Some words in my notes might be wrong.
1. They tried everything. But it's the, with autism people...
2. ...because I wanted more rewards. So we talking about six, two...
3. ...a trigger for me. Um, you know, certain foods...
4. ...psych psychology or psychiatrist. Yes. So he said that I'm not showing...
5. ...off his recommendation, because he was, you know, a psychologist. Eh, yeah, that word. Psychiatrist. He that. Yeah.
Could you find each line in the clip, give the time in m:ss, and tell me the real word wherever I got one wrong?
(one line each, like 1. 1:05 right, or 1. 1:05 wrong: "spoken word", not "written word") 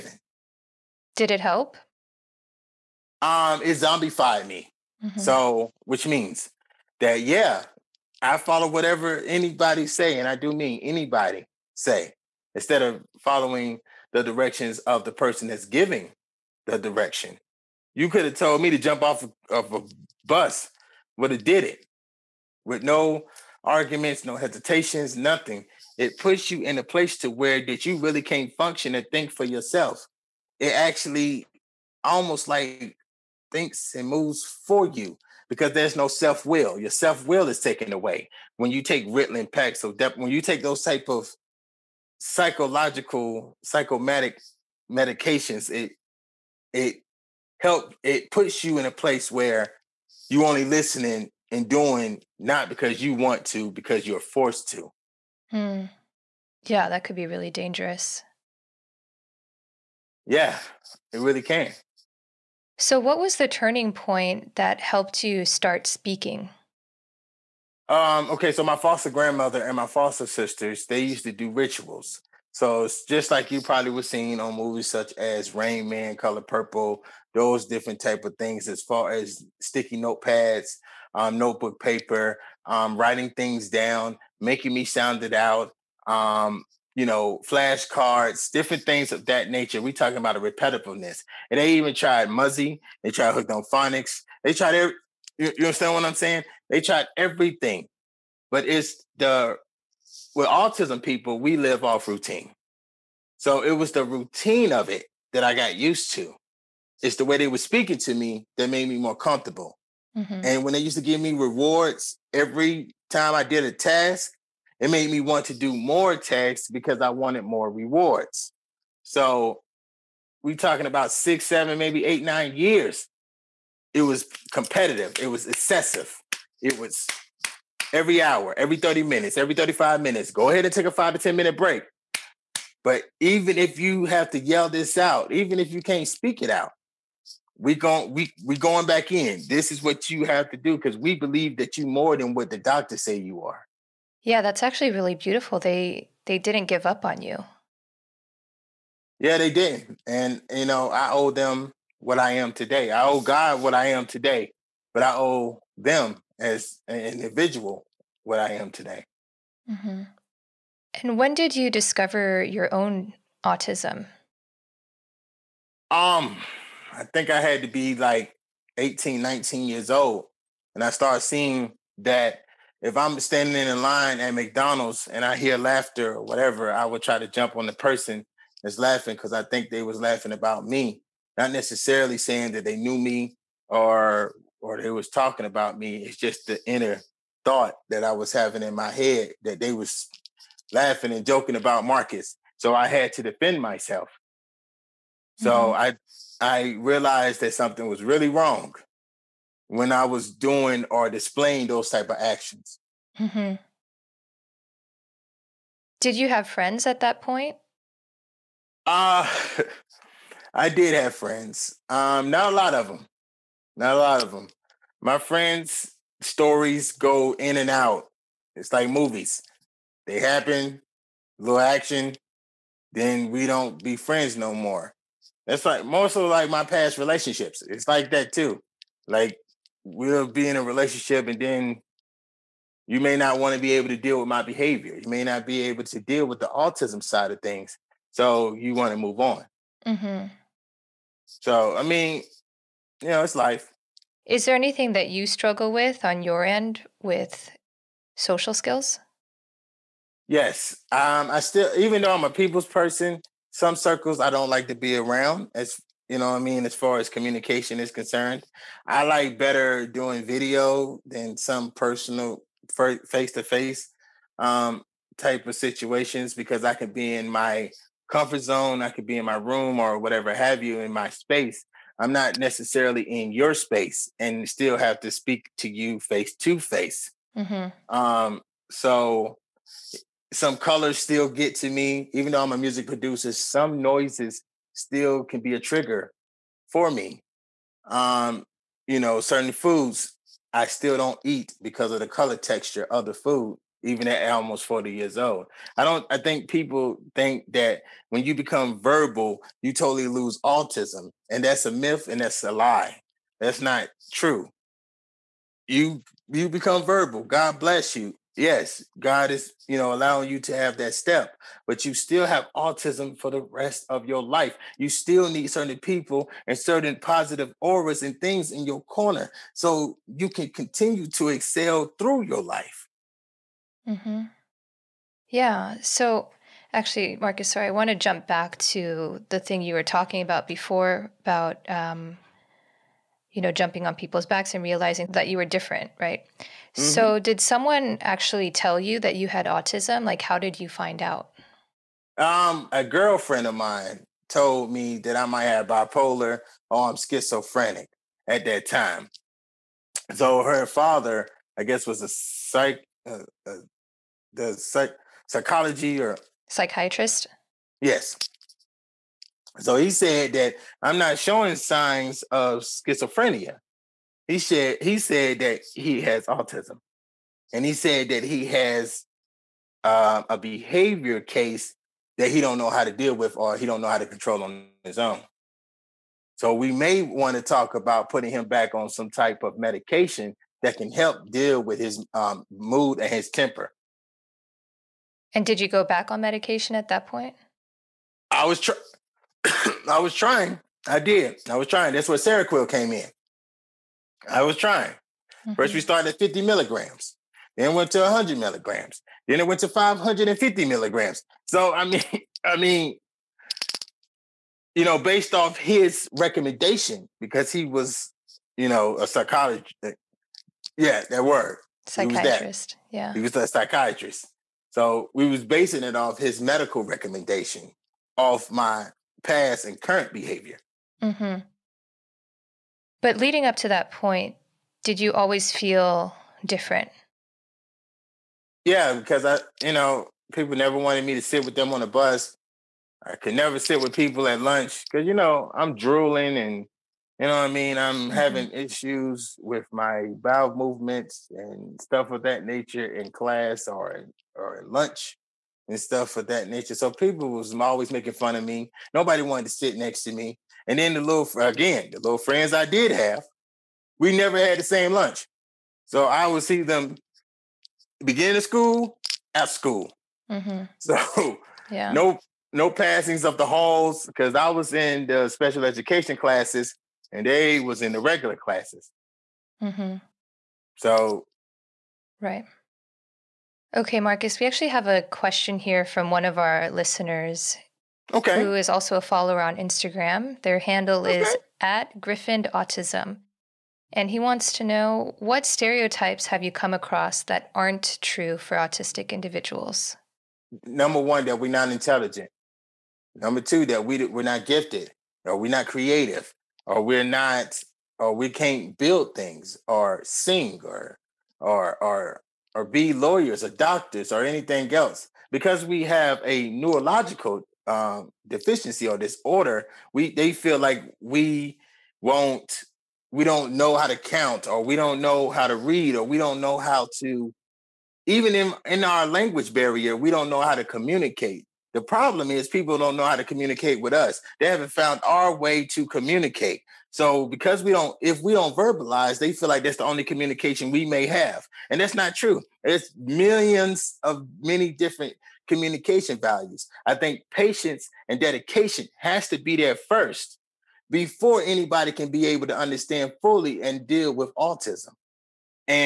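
1. 1:36 right
2. 1:56 wrong: "seven", not "two"
3. 4:45 right
4. 5:54 right
5. 6:45 right.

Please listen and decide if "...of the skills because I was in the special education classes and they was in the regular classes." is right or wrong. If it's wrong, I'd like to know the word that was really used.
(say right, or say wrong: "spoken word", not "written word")
wrong: "halls", not "skills".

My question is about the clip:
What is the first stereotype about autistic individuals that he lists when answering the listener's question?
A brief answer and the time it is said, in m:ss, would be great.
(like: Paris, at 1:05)
Not intelligent, at 8:11.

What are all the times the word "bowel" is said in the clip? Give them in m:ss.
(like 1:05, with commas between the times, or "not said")
7:20.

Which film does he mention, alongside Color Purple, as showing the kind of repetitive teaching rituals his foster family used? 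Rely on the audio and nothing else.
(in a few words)
Rain Man.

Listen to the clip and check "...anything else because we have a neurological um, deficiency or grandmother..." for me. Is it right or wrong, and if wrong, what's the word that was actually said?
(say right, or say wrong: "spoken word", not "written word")
wrong: "disorder", not "grandmother".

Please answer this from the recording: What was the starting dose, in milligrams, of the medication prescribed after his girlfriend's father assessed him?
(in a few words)
50 milligrams.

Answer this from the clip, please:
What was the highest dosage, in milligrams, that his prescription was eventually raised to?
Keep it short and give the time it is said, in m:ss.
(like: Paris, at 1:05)
550 milligrams, at 6:39.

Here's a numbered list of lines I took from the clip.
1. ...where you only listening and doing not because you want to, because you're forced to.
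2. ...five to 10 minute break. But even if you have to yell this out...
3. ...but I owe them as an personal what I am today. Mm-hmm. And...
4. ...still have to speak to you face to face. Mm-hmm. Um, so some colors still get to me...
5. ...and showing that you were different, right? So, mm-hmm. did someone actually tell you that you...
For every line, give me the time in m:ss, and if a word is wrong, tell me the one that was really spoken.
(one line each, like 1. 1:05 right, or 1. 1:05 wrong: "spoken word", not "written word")
1. 0:49 right
2. 2:10 right
3. 2:34 wrong: "individual", not "personal"
4. 4:34 right
5. 5:34 wrong: "realizing", not "showing".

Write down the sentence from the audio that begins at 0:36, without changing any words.
Your self will is taken away when you take Ritalin, Paxil, Dep- when you take those type of psychological, psychomatic medications.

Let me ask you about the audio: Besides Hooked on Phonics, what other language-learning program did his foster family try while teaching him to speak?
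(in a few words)
Muzzy.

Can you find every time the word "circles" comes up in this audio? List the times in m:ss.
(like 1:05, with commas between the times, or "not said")
4:13.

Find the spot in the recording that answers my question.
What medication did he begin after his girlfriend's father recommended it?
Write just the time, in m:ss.
6:32.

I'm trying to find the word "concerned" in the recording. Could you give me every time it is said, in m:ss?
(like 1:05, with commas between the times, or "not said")
4:17.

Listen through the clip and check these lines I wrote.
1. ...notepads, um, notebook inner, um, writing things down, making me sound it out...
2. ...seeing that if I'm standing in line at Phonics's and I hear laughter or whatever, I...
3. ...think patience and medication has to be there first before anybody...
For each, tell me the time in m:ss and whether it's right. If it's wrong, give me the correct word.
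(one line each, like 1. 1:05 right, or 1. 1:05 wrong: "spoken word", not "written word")
1. 1:19 wrong: "paper", not "inner"
2. 2:51 wrong: "McDonald", not "Phonics"
3. 8:56 wrong: "dedication", not "medication".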